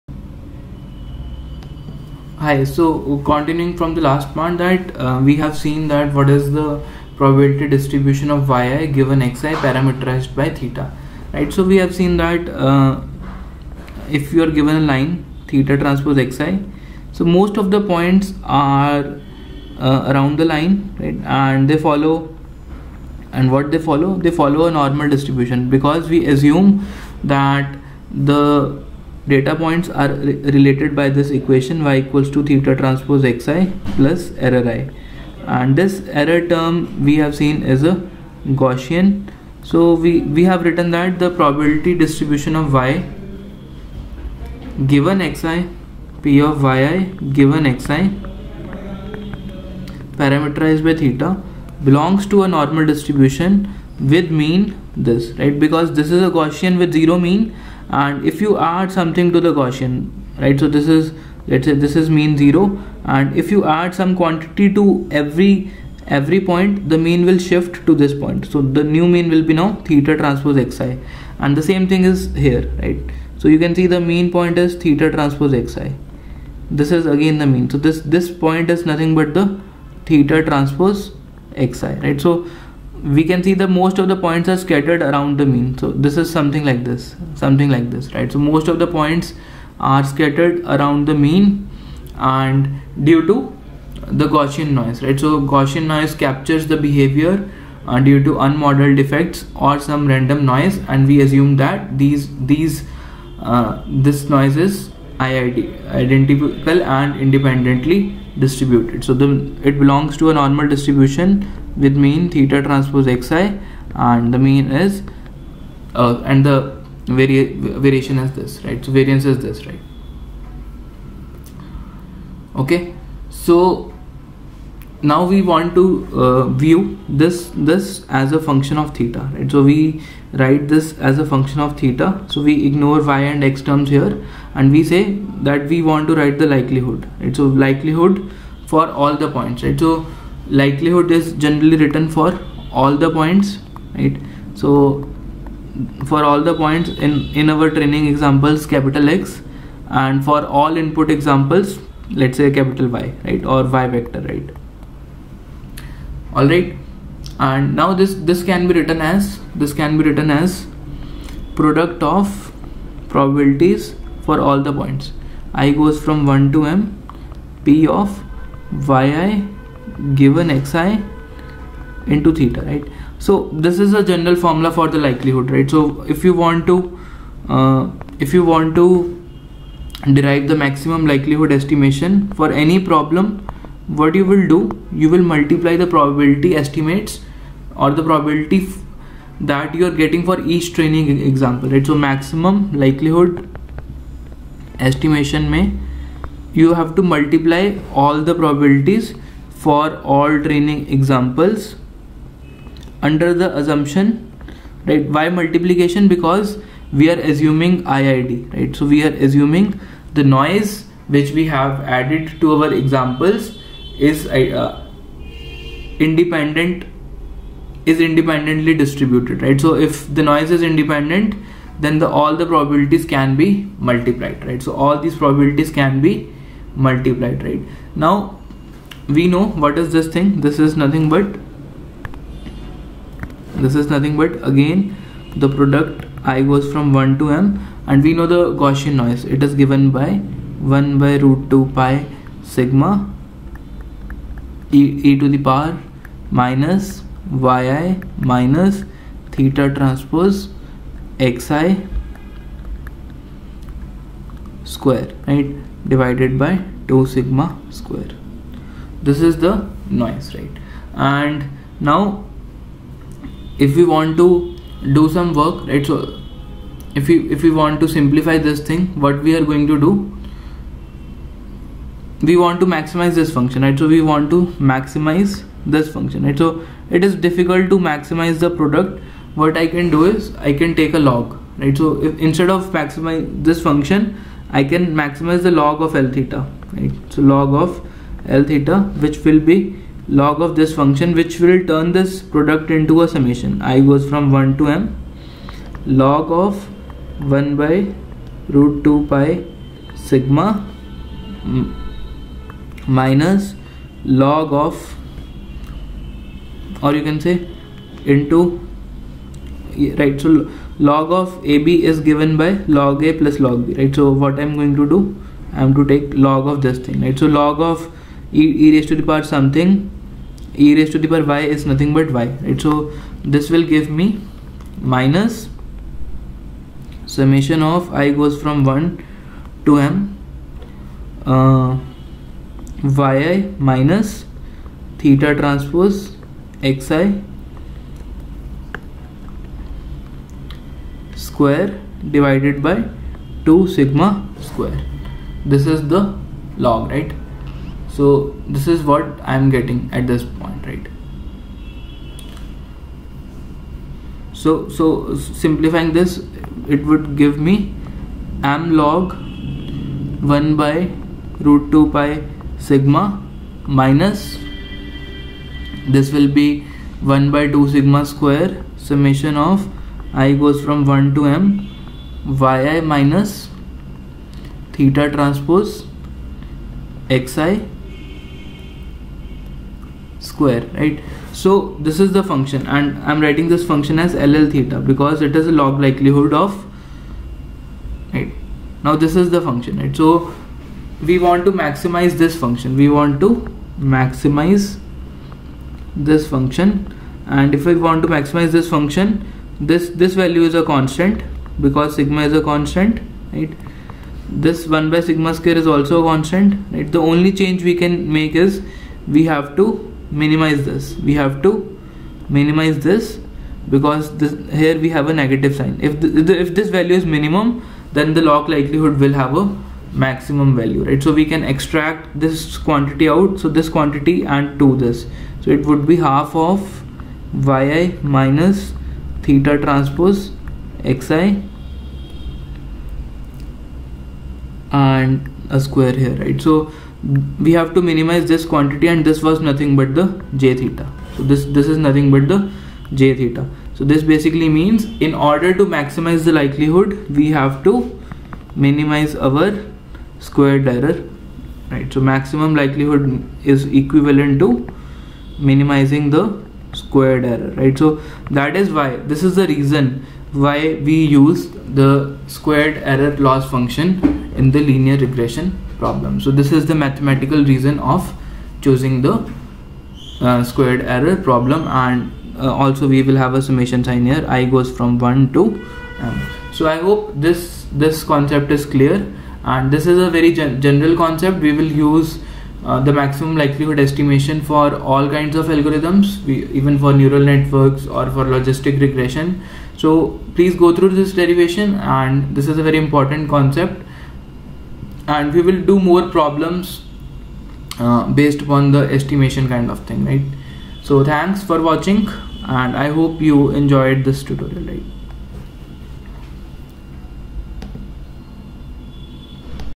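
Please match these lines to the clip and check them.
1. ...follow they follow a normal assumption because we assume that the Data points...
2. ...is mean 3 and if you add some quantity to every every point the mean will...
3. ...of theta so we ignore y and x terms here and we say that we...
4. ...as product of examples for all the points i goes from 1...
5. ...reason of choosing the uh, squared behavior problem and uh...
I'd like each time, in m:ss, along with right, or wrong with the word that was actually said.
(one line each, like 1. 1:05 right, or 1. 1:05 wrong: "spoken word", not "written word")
1. 0:23 wrong: "distribution", not "assumption"
2. 1:02 wrong: "0", not "3"
3. 2:11 right
4. 2:40 wrong: "probabilities", not "examples"
5. 7:47 wrong: "error", not "behavior".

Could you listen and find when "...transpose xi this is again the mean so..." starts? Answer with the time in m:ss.
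1:15.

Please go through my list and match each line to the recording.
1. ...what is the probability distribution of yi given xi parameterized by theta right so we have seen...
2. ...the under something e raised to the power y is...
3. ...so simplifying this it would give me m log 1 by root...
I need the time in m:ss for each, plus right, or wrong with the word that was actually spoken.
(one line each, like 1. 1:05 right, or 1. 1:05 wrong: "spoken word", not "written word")
1. 0:06 right
2. 5:18 wrong: "power", not "under"
3. 5:54 right.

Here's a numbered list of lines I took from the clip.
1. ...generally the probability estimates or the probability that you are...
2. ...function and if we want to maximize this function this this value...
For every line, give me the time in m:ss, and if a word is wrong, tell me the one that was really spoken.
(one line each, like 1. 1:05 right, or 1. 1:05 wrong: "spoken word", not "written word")
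1. 3:05 wrong: "multiply", not "generally"
2. 6:36 right.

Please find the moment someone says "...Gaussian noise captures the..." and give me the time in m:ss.
1:35.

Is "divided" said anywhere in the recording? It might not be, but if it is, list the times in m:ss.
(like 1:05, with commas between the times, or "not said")
4:15, 5:42.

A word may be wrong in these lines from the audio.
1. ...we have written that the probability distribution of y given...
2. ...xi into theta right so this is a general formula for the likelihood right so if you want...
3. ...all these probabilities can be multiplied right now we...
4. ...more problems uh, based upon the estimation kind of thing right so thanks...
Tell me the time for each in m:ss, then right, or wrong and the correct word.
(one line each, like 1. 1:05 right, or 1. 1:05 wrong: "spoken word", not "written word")
1. 0:40 right
2. 2:50 right
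3. 3:44 right
4. 8:15 right.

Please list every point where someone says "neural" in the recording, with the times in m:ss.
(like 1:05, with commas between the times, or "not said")
8:06.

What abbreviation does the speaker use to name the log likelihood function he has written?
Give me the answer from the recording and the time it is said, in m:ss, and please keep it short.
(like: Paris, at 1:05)
ll theta, at 6:24.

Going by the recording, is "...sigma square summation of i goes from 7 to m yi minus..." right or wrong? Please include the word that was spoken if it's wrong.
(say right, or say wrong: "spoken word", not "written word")
wrong: "1", not "7".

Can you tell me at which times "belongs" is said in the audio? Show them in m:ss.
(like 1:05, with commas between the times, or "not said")
0:51, 1:49.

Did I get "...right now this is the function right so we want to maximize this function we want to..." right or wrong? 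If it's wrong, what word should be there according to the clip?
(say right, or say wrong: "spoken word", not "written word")
right.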